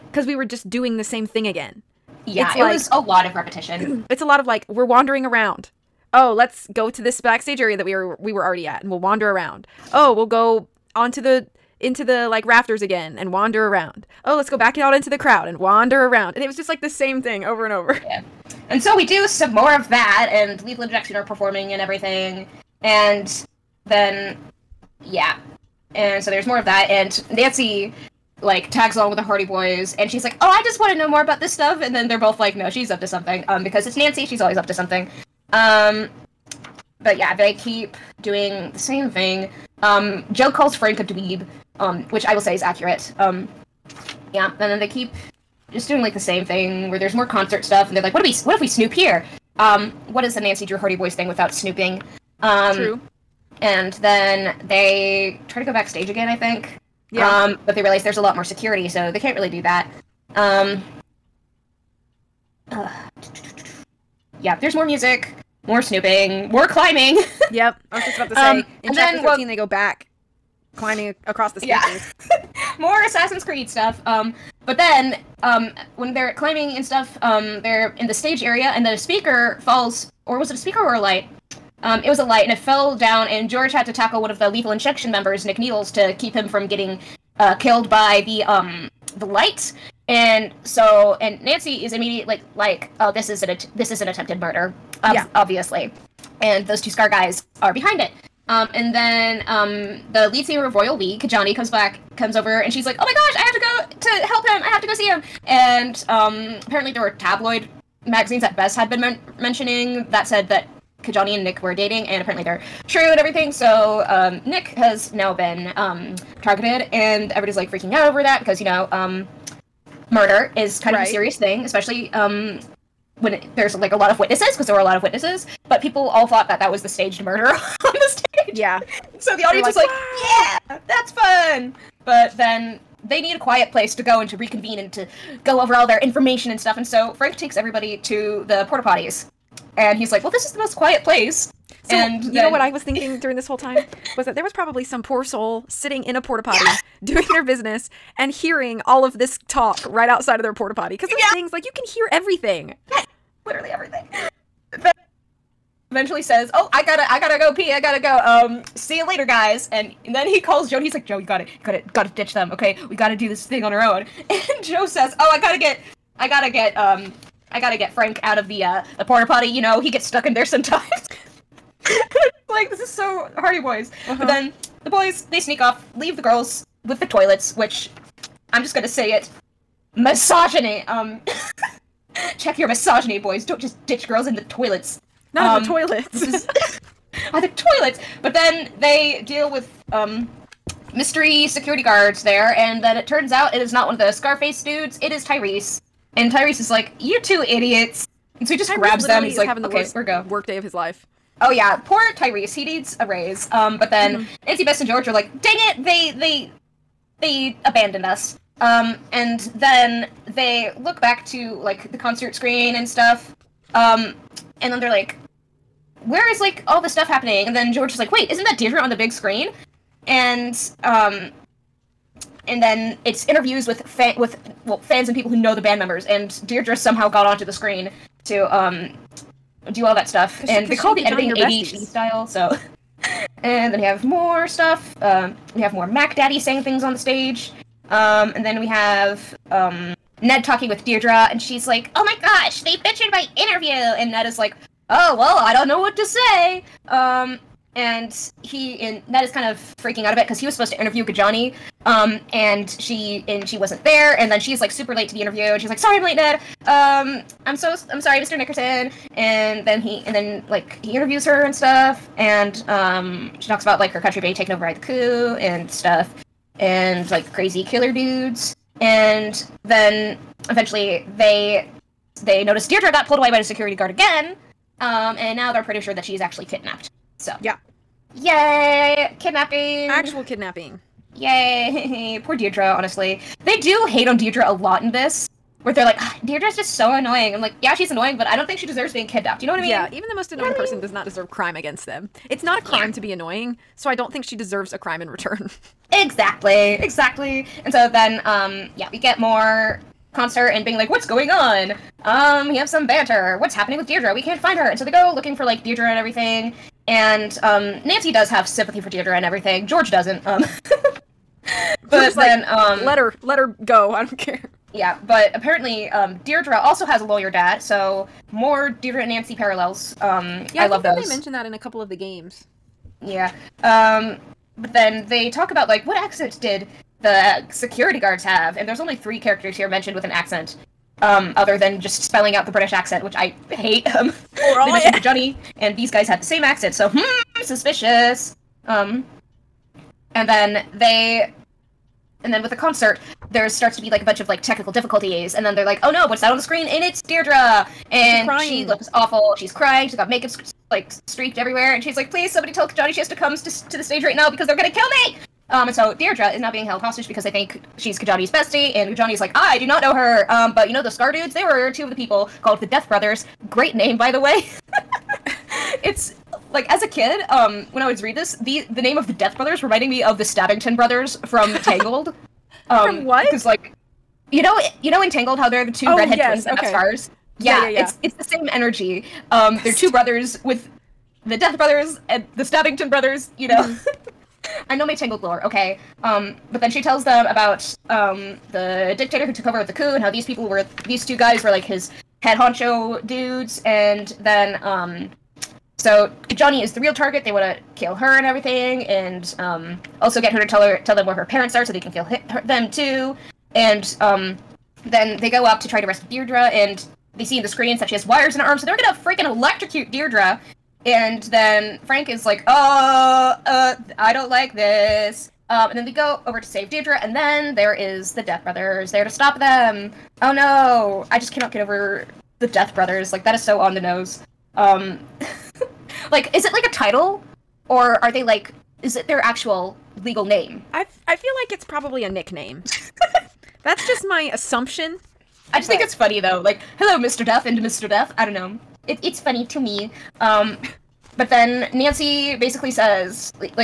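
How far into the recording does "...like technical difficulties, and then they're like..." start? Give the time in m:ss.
5:44.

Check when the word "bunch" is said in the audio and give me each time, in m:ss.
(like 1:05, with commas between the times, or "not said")
5:44.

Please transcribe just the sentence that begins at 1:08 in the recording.
Um, in chapter then, 13, well, they go back climbing across the staircase.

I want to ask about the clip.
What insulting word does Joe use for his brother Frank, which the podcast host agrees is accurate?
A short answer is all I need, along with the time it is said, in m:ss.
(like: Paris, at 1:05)
dweeb, at 0:41.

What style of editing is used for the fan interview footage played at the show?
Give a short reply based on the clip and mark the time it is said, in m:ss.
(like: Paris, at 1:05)
ADHD style, at 3:51.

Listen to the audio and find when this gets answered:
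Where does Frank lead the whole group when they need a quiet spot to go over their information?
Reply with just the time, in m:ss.
2:18.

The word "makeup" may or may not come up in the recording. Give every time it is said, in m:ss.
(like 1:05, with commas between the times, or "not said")
5:50.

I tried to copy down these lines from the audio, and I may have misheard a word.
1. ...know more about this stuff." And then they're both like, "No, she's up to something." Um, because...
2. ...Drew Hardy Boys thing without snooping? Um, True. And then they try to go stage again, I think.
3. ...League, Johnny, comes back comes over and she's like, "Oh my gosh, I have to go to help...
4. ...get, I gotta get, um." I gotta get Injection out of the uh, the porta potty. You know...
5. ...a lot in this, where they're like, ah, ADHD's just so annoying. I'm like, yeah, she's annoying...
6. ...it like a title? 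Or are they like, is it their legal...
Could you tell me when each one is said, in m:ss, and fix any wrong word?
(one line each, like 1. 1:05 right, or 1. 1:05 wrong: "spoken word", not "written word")
1. 0:30 right
2. 0:50 wrong: "backstage", not "stage"
3. 1:40 right
4. 2:45 wrong: "Frank", not "Injection"
5. 4:44 wrong: "Deirdre", not "ADHD"
6. 7:06 wrong: "actual", not "legal".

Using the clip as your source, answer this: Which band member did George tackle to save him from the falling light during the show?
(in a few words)
Nick Needles.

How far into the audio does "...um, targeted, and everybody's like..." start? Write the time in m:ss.
1:55.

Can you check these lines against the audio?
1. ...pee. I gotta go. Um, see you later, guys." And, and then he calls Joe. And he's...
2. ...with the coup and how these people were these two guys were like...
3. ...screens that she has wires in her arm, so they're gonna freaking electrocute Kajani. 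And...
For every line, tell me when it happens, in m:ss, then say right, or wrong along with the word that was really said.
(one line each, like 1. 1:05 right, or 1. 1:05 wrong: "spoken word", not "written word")
1. 2:37 right
2. 6:29 right
3. 6:47 wrong: "Deirdre", not "Kajani".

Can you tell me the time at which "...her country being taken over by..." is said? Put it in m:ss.
4:23.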